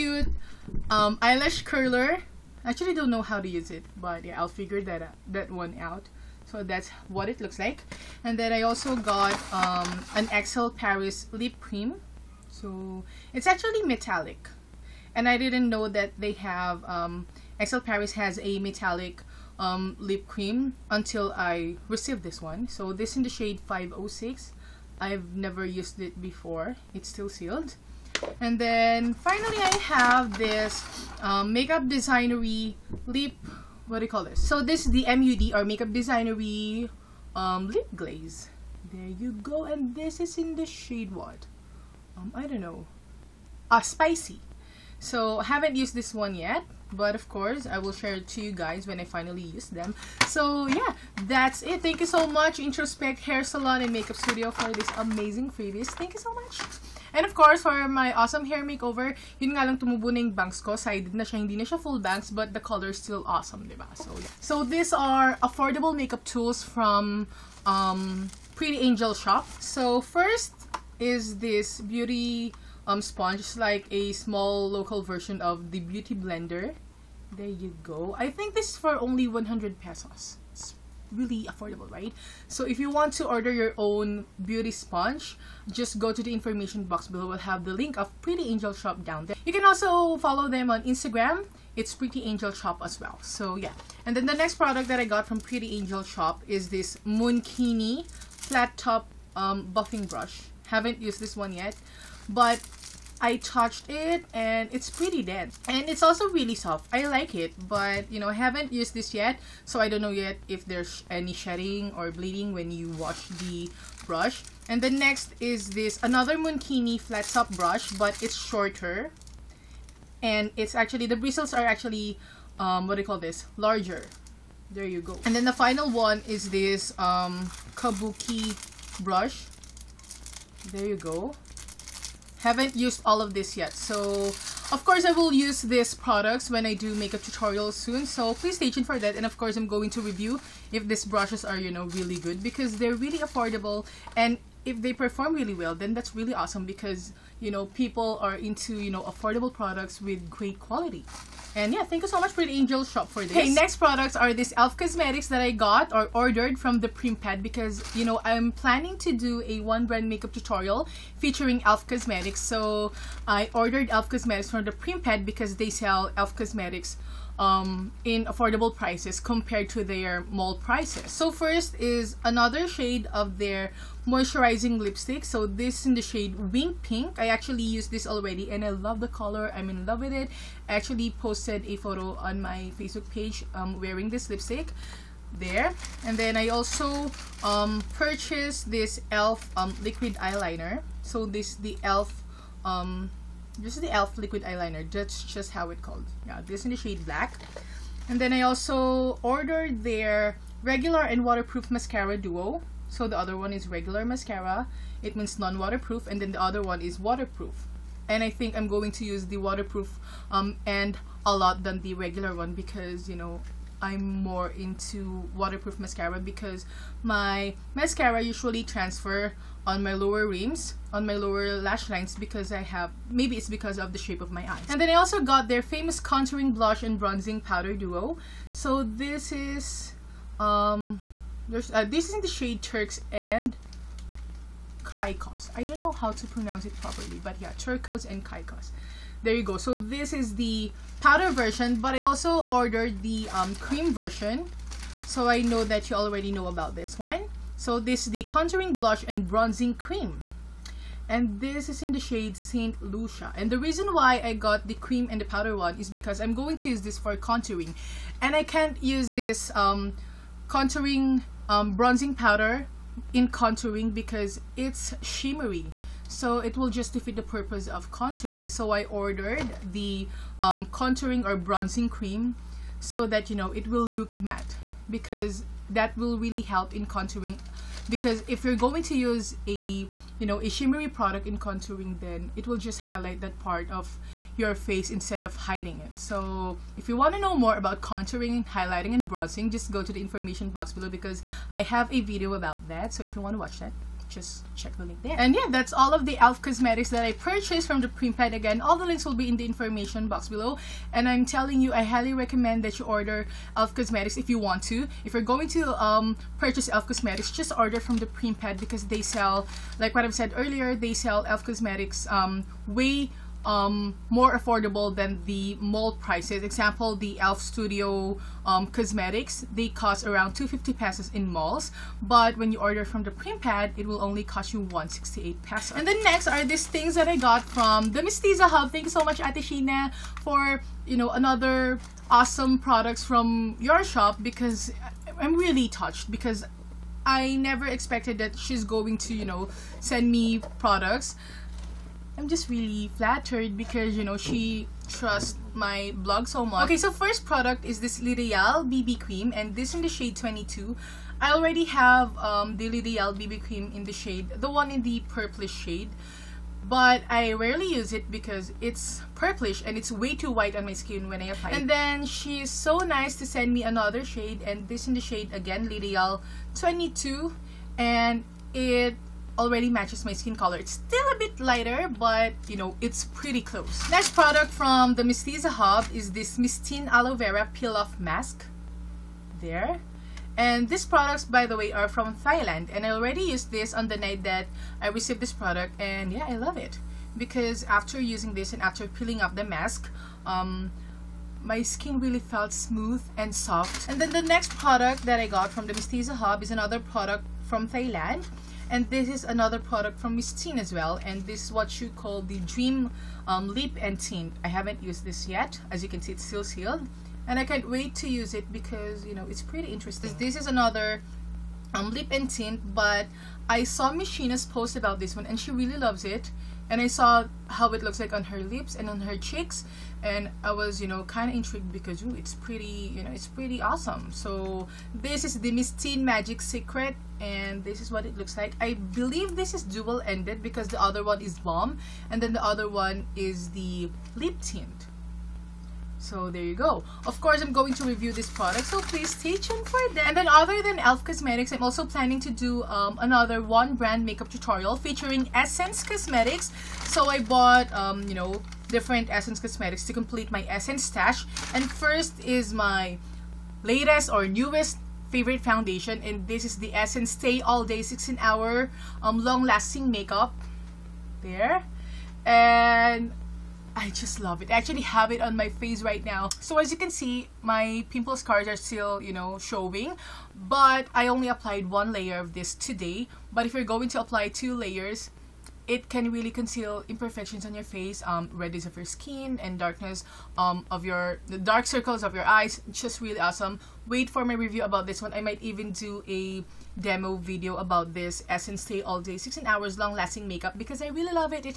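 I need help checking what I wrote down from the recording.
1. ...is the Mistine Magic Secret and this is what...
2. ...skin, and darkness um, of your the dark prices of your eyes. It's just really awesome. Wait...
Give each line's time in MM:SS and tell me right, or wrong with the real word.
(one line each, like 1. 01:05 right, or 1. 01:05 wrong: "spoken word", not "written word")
1. 07:05 right
2. 07:58 wrong: "circles", not "prices".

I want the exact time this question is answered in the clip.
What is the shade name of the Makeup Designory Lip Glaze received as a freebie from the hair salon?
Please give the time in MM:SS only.
00:43.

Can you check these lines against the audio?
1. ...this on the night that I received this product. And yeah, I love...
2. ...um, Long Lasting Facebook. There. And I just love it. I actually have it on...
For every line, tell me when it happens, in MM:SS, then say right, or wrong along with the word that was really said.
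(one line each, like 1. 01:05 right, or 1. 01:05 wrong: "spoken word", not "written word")
1. 06:23 right
2. 07:39 wrong: "Makeup", not "Facebook".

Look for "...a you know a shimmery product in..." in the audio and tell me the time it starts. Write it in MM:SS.
04:39.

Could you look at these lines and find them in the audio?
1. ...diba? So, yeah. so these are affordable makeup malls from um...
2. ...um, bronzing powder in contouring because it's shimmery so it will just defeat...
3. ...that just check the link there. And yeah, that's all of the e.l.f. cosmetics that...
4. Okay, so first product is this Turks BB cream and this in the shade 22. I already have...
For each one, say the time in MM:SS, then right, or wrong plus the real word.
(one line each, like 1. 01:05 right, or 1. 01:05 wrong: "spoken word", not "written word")
1. 01:03 wrong: "tools", not "malls"
2. 04:21 right
3. 04:53 right
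4. 05:46 wrong: "Lideal", not "Turks".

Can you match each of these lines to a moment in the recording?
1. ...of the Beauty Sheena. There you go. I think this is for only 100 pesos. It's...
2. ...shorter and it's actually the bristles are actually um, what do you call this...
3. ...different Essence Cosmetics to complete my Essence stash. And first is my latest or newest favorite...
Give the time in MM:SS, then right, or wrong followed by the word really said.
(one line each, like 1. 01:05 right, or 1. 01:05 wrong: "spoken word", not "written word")
1. 01:15 wrong: "Blender", not "Sheena"
2. 01:58 right
3. 07:28 right.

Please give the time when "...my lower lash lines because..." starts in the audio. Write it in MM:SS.
03:41.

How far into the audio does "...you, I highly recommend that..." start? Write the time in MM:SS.
05:01.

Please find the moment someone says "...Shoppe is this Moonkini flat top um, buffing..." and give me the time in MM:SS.
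01:36.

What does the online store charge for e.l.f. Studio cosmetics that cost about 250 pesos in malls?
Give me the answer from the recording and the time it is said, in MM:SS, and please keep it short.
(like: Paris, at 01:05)
168 pesos, at 05:24.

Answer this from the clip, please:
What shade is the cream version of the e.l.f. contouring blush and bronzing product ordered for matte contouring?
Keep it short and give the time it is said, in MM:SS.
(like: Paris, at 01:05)
Saint Lucia, at 04:12.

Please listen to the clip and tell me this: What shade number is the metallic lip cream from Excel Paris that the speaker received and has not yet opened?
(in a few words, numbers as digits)
506.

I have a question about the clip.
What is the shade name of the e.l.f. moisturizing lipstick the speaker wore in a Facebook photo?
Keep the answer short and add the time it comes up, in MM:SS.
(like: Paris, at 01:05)
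Wink Pink, at 02:56.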